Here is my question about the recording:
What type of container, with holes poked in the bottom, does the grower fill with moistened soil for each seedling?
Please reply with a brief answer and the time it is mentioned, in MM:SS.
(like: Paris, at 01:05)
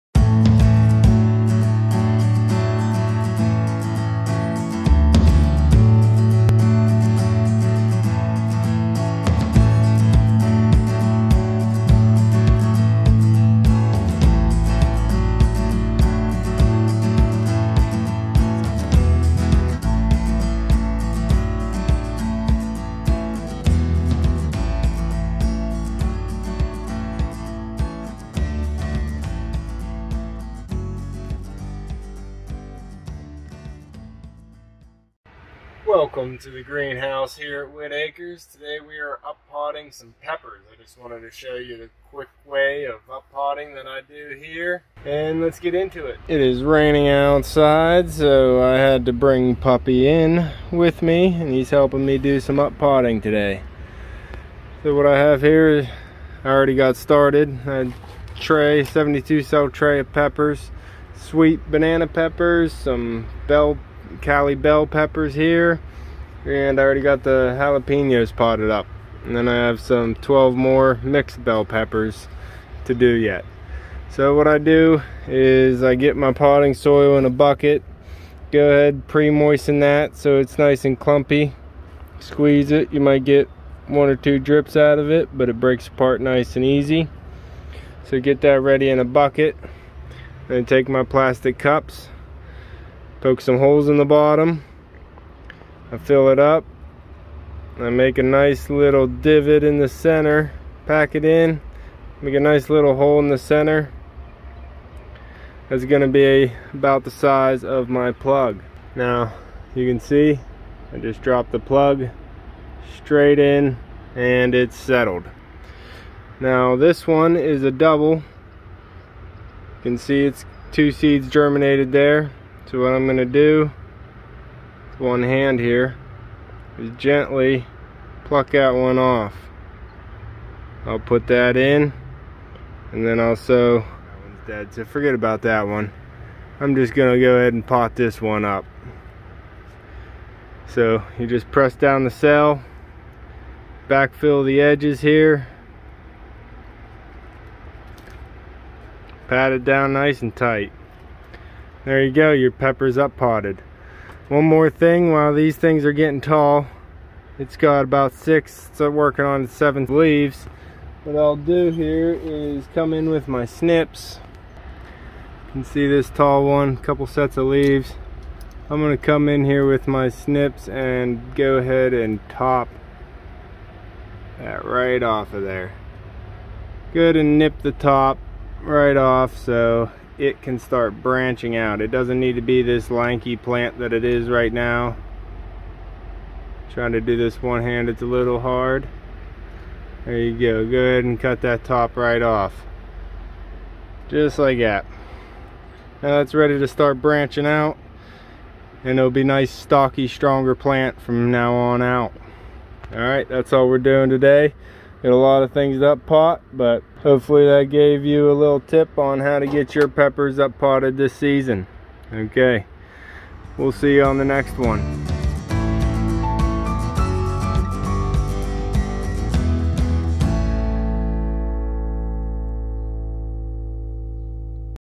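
Plastic cups, at 01:31.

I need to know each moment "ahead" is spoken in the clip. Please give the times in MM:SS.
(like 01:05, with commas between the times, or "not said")
01:18, 02:17, 02:51, 03:10.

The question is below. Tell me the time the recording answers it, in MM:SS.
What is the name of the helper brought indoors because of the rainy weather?
00:49.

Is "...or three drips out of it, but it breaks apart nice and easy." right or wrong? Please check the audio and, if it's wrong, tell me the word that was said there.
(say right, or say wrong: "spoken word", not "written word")
wrong: "two", not "three".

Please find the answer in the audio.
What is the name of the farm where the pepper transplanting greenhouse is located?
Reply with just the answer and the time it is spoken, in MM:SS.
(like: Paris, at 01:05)
Whitt Acres, at 00:37.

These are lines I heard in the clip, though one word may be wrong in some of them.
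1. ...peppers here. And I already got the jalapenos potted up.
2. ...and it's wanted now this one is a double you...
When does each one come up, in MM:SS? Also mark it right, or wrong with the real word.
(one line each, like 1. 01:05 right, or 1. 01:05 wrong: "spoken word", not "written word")
1. 01:04 right
2. 01:54 wrong: "settled", not "wanted".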